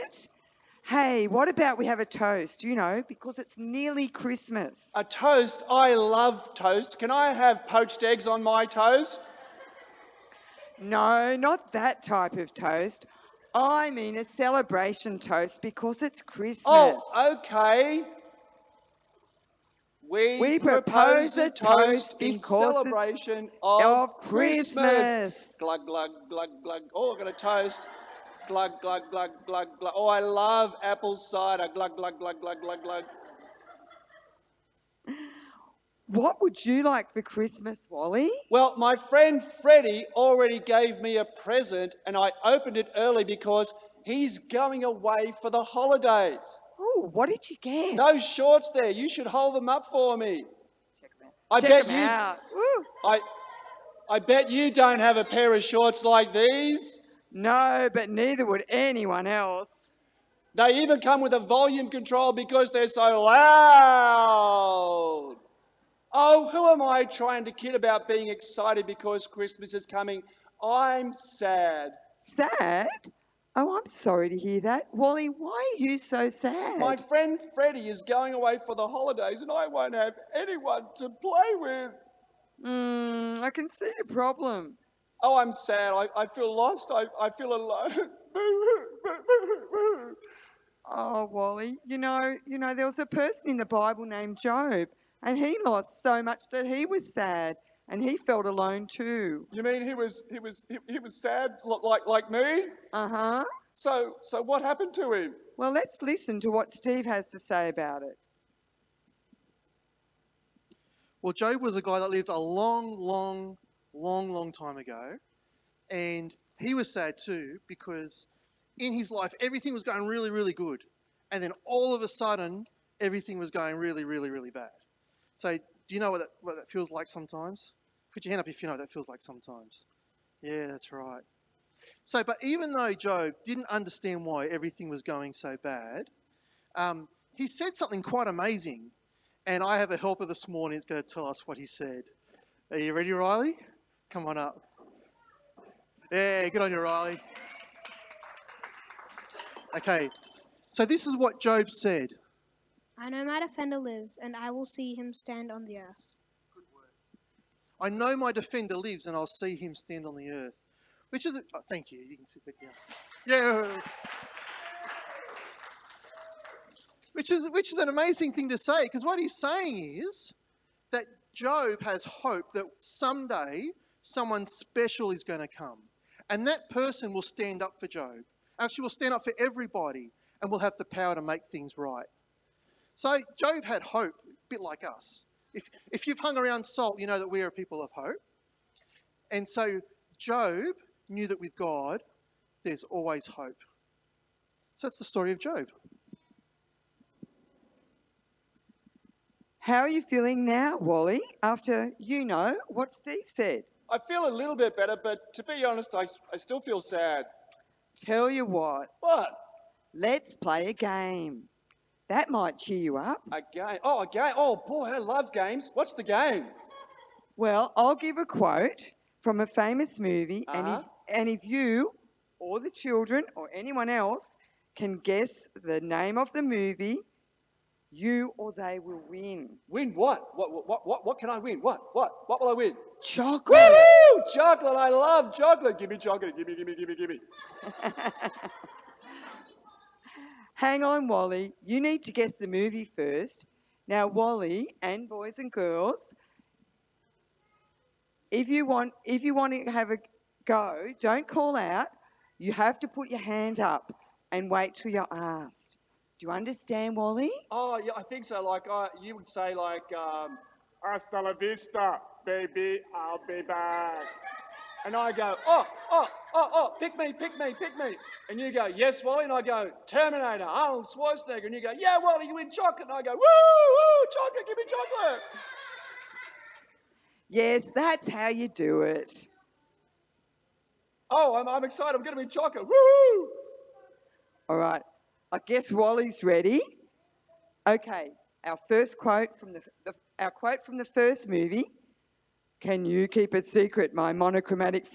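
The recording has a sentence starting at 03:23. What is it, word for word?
I feel a little bit better, but to be honest, I, I still feel sad.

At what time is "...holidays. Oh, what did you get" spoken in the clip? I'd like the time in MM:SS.
00:45.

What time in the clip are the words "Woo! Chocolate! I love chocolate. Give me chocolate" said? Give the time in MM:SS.
03:53.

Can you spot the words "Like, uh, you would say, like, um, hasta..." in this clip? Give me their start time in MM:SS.
04:18.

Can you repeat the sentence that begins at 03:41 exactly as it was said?
if, and if you or the children or anyone else can guess the name of the movie, you or they will win.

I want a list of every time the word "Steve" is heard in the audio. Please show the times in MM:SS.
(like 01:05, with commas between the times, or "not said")
01:46, 03:22.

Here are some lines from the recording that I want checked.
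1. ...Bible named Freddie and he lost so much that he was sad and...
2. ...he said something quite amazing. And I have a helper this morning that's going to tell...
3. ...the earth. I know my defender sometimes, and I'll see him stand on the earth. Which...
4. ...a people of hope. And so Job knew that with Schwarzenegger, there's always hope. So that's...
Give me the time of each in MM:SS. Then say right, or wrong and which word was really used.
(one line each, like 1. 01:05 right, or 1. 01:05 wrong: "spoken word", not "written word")
1. 01:33 wrong: "Job", not "Freddie"
2. 02:17 right
3. 02:35 wrong: "lives", not "sometimes"
4. 03:07 wrong: "God", not "Schwarzenegger".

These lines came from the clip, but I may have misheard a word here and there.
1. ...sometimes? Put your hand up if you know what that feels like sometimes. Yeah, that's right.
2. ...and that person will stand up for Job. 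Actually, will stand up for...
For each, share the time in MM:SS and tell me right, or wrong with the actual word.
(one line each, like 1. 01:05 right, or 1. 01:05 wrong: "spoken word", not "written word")
1. 02:07 right
2. 02:56 right.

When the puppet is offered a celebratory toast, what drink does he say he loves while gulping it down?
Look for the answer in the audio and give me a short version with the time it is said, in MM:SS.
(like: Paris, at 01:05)
Apple cider, at 00:30.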